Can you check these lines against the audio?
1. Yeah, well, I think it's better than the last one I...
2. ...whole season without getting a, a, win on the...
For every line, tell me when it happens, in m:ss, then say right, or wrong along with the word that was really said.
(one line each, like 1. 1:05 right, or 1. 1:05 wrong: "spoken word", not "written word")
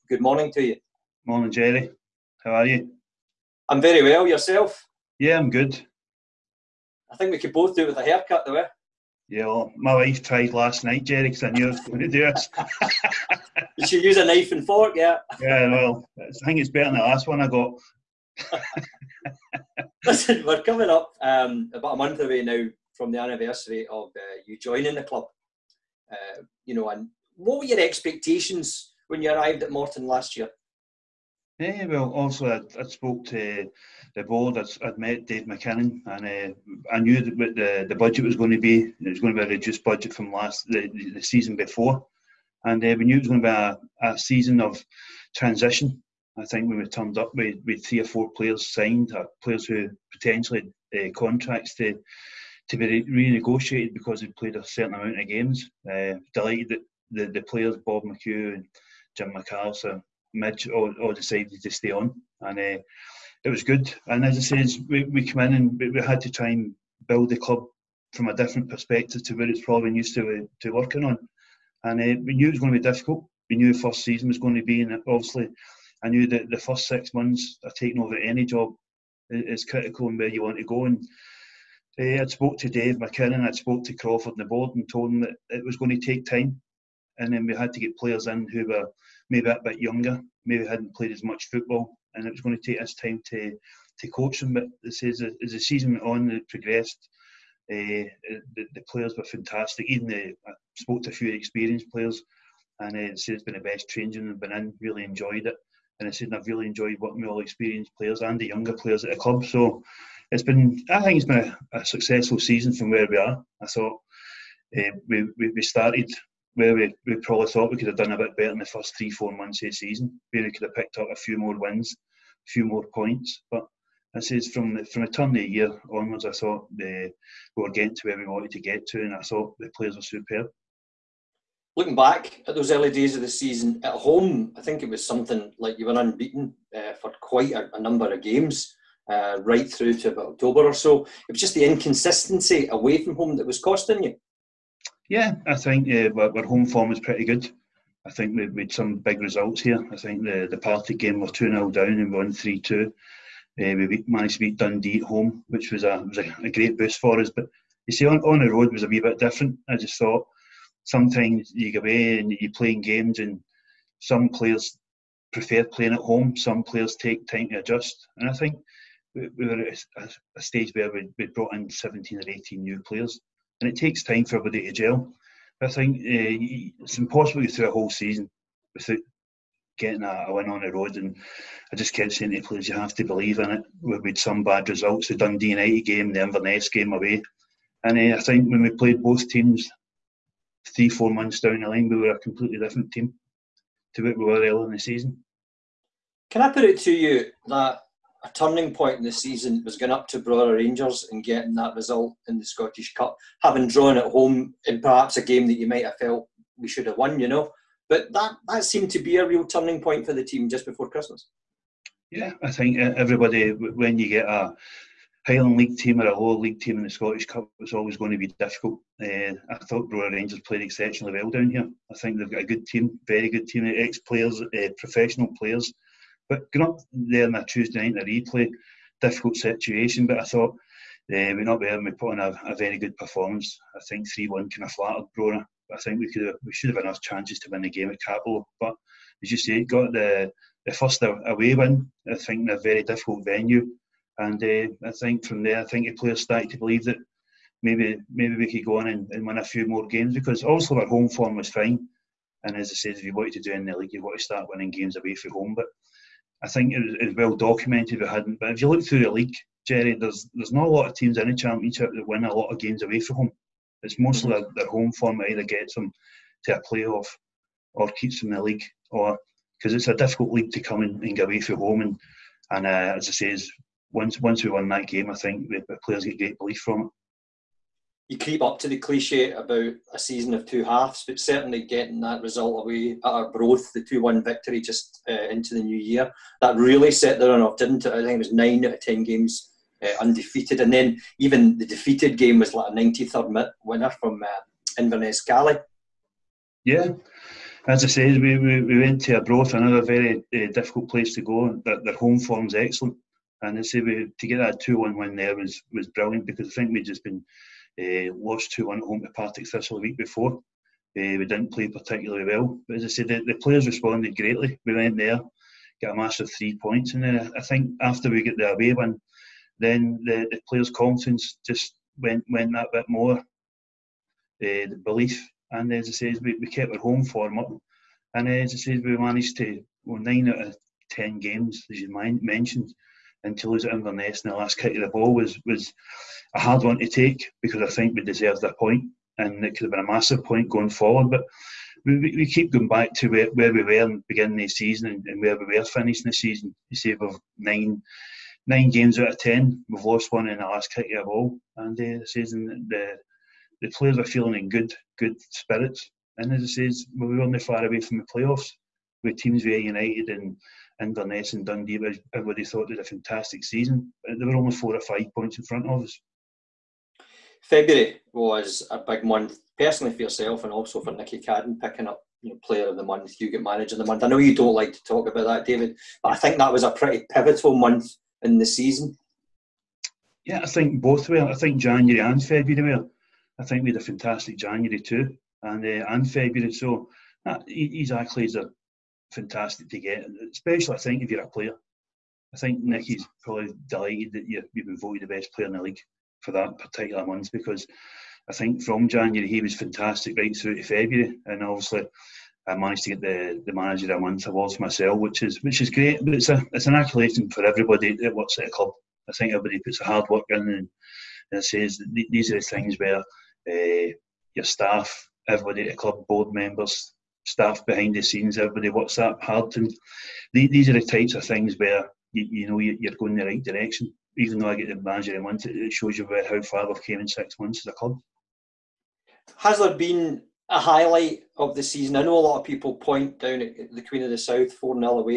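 1. 0:15 right
2. 2:57 right.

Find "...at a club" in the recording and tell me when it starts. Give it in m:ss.
6:48.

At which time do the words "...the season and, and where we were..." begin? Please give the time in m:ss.
5:44.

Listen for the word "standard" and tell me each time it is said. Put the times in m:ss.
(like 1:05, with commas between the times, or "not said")
not said.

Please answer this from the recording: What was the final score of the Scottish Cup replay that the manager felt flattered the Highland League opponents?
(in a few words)
3-1.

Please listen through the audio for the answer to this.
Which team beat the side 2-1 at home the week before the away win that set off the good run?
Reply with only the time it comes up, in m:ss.
5:09.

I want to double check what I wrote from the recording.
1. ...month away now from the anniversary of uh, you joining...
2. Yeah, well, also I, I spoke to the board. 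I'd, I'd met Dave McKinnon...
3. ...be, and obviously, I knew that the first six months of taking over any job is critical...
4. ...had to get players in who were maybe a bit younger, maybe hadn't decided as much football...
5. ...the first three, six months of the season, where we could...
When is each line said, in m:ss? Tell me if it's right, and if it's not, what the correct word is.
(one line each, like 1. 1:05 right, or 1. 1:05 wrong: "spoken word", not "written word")
1. 0:21 right
2. 0:31 right
3. 1:14 right
4. 1:27 wrong: "played", not "decided"
5. 1:58 wrong: "four", not "six".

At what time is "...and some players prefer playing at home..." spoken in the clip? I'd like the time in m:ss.
2:43.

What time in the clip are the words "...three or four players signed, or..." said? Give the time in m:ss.
0:47.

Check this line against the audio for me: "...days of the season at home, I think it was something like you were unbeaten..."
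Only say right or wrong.
right.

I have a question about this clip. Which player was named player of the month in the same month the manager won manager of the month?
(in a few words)
Nicky Cadden.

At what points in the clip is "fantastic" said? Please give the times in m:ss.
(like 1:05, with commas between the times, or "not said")
1:39, 6:02, 6:23, 6:29, 6:39.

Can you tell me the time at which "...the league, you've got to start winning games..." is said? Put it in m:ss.
4:13.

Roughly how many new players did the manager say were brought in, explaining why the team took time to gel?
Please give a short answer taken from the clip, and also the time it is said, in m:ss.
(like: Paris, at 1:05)
17 or 18, at 2:51.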